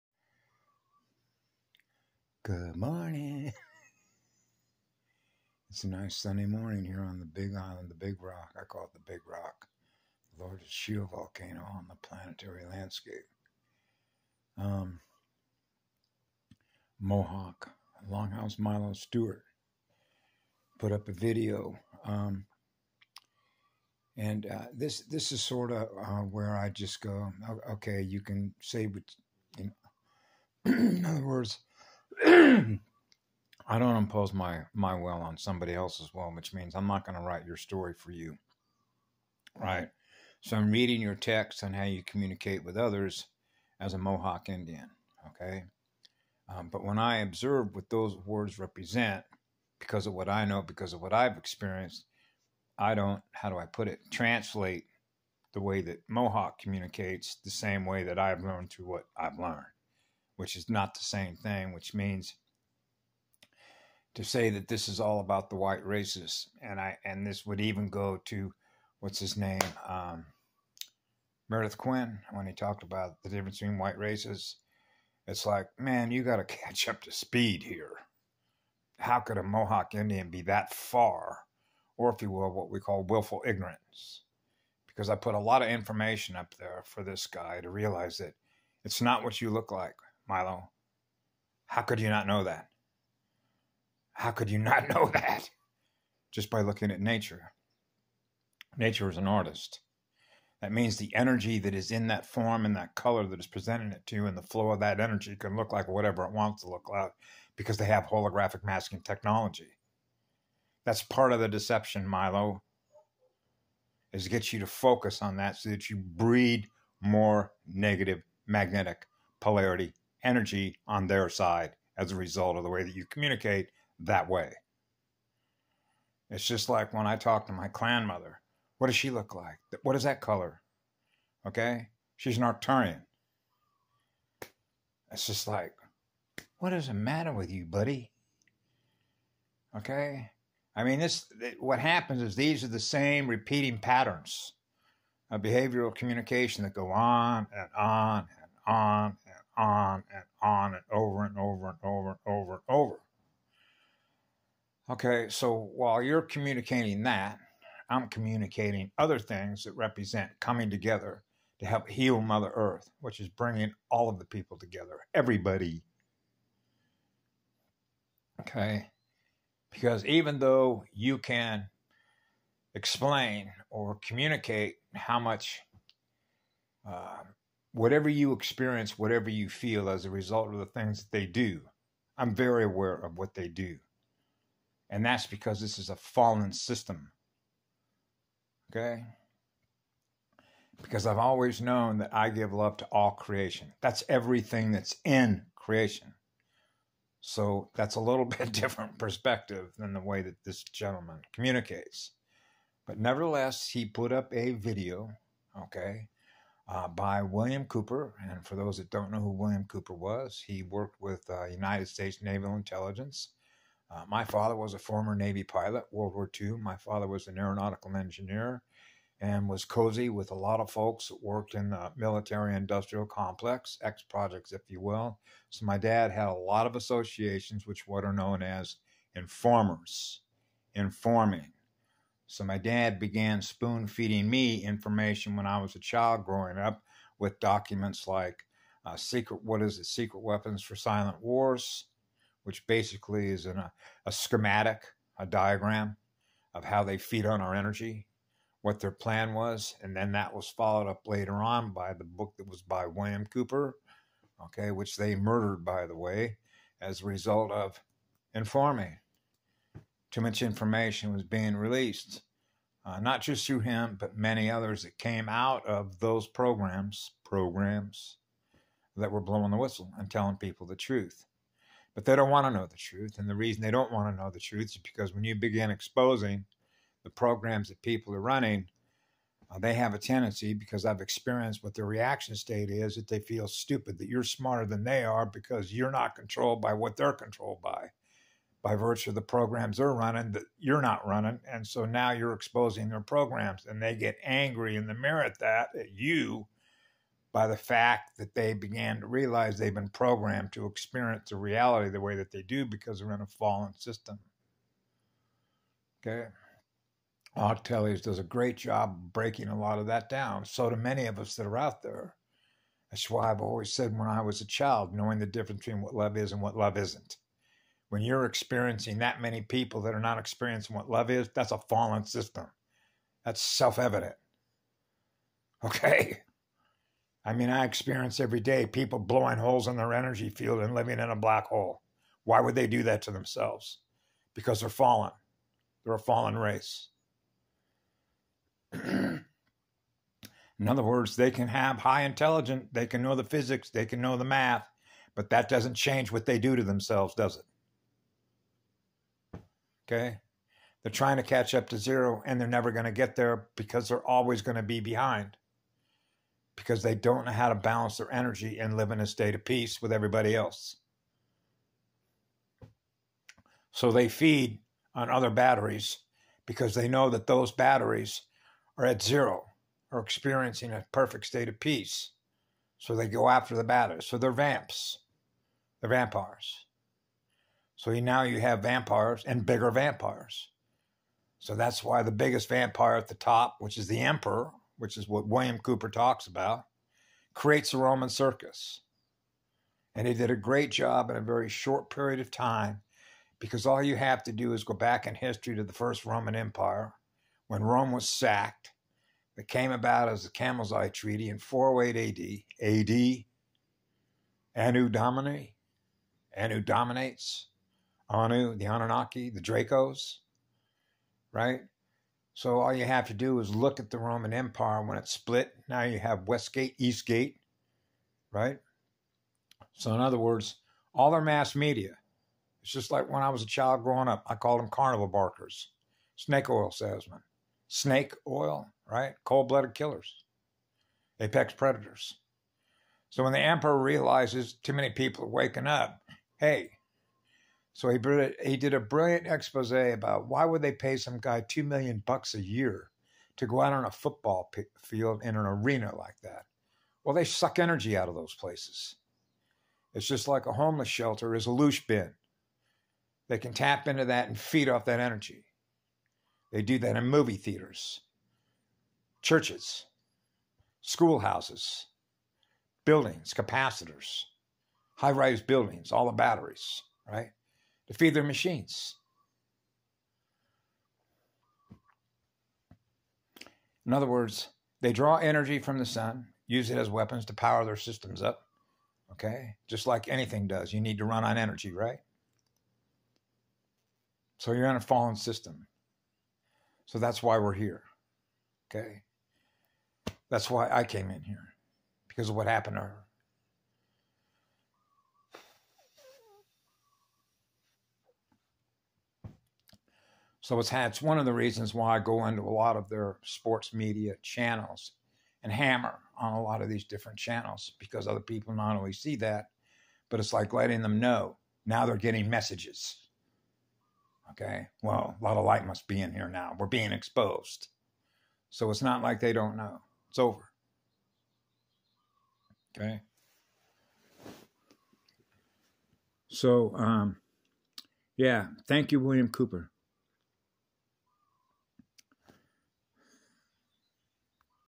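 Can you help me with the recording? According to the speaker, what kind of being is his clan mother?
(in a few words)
An Arcturian.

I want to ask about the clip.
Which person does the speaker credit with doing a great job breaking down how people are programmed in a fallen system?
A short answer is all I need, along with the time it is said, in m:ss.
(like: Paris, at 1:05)
Octelius, at 5:07.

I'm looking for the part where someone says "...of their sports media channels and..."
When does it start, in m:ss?
8:22.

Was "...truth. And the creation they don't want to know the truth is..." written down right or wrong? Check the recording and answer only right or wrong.
wrong.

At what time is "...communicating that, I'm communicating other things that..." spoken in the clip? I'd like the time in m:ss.
2:36.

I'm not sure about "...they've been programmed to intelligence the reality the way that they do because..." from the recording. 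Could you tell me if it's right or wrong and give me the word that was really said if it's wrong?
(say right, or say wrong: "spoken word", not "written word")
wrong: "experience", not "intelligence".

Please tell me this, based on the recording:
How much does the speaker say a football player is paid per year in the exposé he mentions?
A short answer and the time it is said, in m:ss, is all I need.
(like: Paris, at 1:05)
2 million dollars, at 7:21.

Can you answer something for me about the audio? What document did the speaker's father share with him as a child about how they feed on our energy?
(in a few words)
Secret Weapons for Silent Wars.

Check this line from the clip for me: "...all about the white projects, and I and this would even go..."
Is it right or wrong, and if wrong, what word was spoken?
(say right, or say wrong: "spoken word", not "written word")
wrong: "racists", not "projects".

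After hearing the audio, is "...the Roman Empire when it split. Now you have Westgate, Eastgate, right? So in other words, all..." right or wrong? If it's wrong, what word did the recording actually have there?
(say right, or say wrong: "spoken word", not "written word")
right.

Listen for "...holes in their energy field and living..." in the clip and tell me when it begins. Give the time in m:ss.
5:29.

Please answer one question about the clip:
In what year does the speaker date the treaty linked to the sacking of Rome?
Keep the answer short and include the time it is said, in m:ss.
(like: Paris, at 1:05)
408 AD, at 6:41.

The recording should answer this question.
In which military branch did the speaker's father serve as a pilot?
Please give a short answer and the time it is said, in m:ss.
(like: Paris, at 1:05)
Navy, at 3:35.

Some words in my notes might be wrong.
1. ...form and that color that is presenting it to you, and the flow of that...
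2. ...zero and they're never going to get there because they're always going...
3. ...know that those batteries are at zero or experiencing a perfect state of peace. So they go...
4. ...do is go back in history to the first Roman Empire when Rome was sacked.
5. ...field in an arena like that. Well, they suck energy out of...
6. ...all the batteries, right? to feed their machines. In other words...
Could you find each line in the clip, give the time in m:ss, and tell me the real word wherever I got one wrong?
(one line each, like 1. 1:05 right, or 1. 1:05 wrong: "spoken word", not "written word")
1. 1:42 right
2. 5:51 right
3. 6:06 right
4. 6:34 right
5. 7:24 right
6. 7:45 right.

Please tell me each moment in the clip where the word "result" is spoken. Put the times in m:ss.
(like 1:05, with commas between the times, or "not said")
2:02, 3:00, 4:17.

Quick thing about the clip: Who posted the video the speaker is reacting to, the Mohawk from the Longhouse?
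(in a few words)
Milo Stewart.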